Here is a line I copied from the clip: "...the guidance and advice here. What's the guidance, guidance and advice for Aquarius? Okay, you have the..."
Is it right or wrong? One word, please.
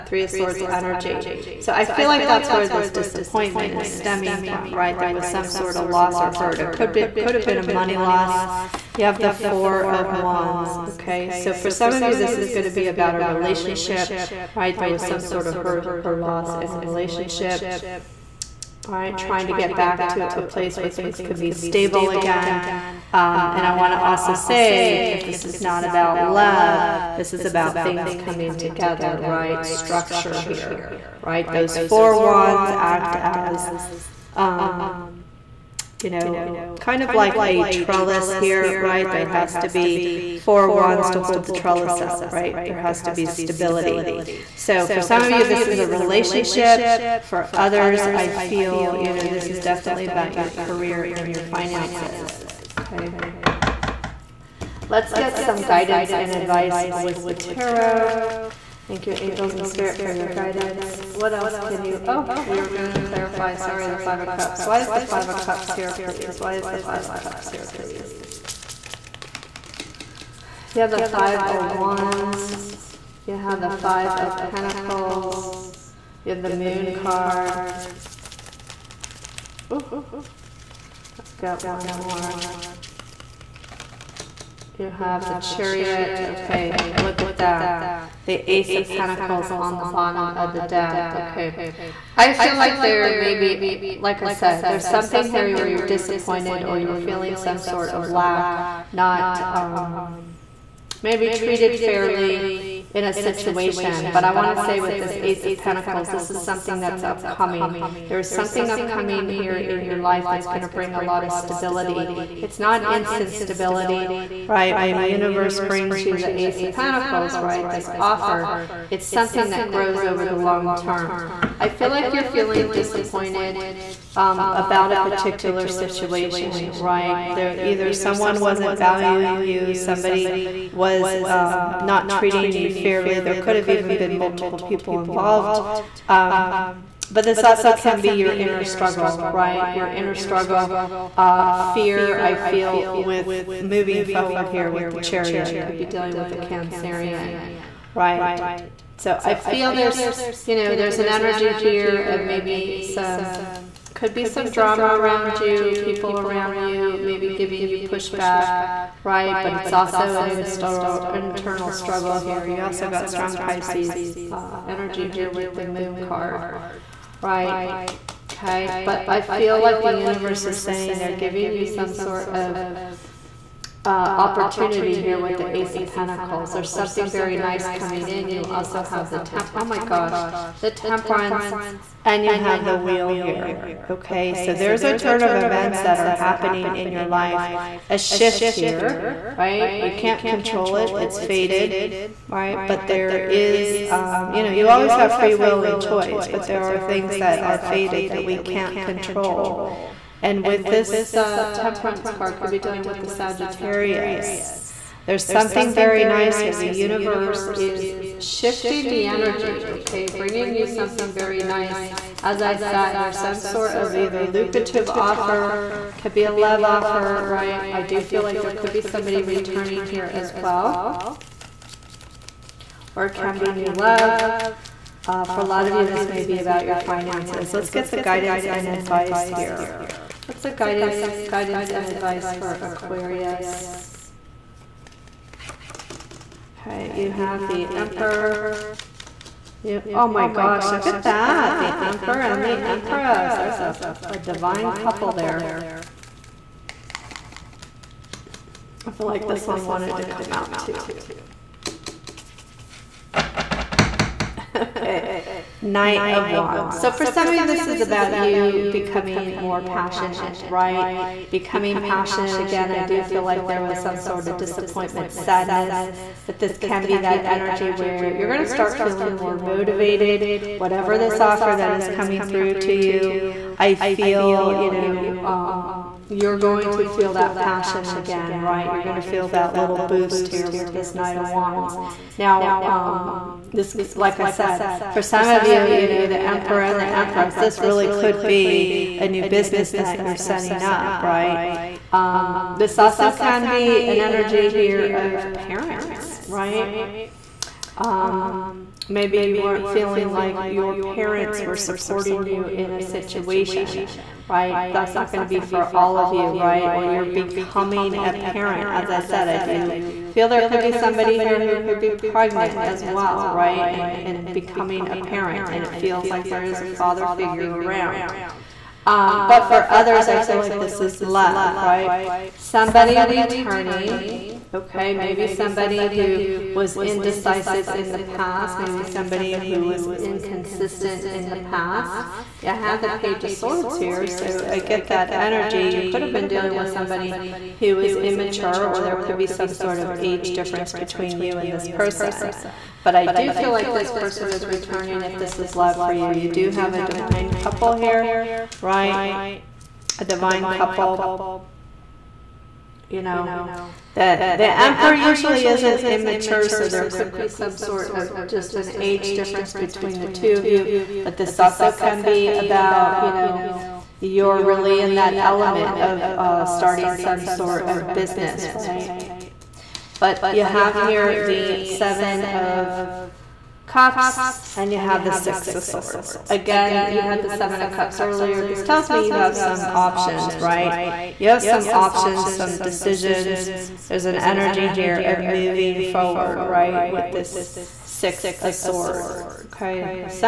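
right.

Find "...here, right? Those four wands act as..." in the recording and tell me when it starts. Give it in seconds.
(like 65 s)
30 s.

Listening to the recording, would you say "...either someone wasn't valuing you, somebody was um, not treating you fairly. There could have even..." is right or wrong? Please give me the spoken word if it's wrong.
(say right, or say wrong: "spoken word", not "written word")
right.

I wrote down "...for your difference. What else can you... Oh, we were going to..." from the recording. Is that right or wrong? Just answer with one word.
wrong.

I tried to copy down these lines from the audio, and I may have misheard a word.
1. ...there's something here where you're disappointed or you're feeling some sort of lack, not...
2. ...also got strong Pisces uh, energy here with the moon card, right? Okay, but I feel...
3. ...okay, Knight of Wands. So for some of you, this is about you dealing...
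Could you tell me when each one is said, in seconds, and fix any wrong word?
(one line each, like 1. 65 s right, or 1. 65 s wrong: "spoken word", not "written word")
1. 94 s right
2. 162 s right
3. 254 s wrong: "becoming", not "dealing".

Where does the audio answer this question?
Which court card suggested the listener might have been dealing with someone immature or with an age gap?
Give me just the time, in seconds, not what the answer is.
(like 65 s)
332 s.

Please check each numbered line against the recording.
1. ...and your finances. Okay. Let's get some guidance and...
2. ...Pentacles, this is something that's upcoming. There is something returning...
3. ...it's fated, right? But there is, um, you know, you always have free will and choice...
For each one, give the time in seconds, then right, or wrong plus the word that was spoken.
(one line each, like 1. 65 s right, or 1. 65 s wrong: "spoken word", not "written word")
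1. 51 s right
2. 105 s wrong: "upcoming", not "returning"
3. 190 s right.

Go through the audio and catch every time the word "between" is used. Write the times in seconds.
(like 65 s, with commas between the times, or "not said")
340 s, 359 s.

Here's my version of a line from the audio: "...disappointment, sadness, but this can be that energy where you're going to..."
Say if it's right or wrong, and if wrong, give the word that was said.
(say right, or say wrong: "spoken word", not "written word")
right.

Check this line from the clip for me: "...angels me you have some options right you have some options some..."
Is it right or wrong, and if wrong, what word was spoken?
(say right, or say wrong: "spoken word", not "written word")
wrong: "tells", not "angels".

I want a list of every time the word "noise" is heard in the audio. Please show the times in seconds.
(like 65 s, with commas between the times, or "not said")
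not said.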